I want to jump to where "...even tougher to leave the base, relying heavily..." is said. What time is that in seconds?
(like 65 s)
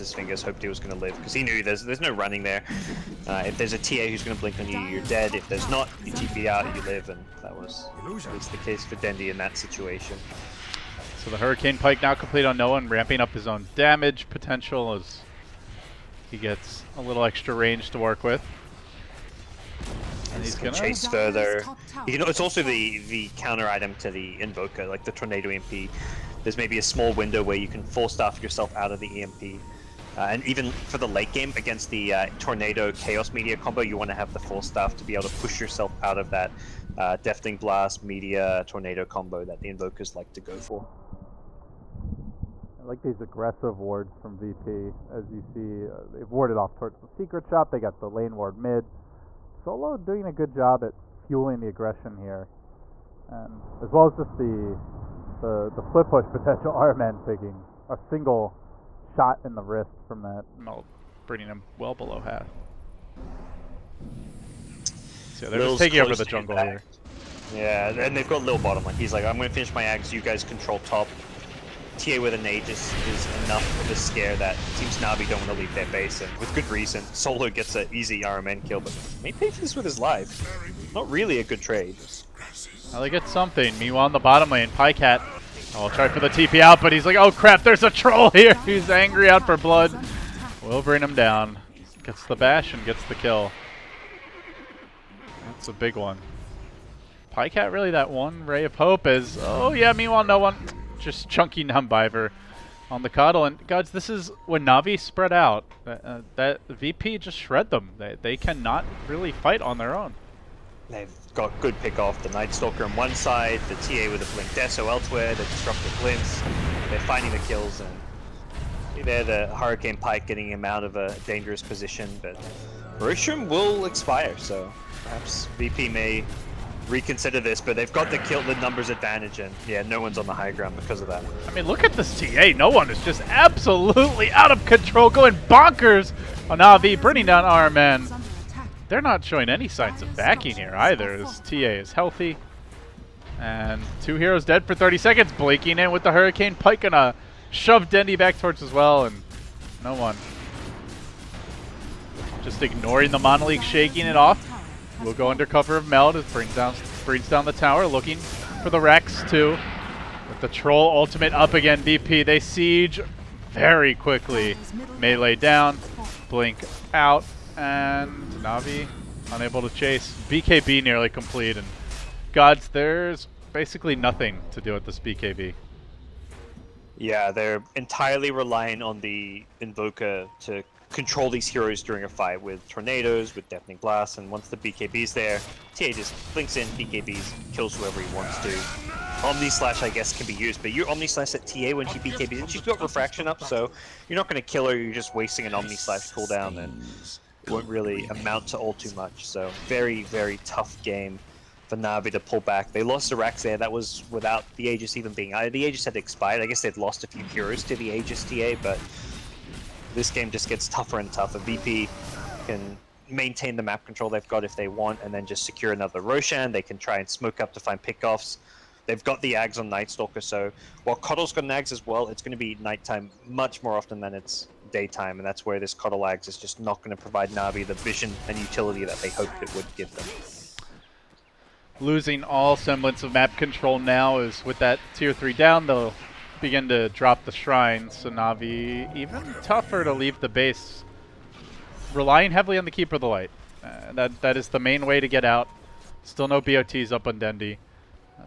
238 s.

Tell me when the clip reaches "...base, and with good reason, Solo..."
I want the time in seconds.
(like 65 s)
75 s.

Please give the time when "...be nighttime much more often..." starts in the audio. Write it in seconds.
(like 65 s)
222 s.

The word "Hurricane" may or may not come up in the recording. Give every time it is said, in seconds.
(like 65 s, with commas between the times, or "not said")
11 s, 119 s, 146 s.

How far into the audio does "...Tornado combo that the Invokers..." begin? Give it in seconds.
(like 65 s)
38 s.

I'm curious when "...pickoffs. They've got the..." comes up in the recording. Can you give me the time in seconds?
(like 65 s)
217 s.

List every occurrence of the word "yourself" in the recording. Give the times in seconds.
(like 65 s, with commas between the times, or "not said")
28 s, 35 s.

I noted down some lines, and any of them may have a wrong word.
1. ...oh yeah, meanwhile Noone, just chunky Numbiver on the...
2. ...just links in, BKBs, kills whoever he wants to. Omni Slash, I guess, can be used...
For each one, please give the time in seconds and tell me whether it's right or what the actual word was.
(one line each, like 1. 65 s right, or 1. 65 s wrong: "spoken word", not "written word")
1. 99 s right
2. 185 s right.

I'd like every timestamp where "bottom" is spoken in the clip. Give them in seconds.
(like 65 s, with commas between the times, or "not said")
68 s, 84 s.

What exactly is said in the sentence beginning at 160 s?
With the Troll ultimate up again, DP.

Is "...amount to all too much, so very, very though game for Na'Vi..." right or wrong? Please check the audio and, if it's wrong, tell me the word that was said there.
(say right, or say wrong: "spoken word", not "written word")
wrong: "tough", not "though".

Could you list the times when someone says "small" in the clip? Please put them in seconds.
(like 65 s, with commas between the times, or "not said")
26 s.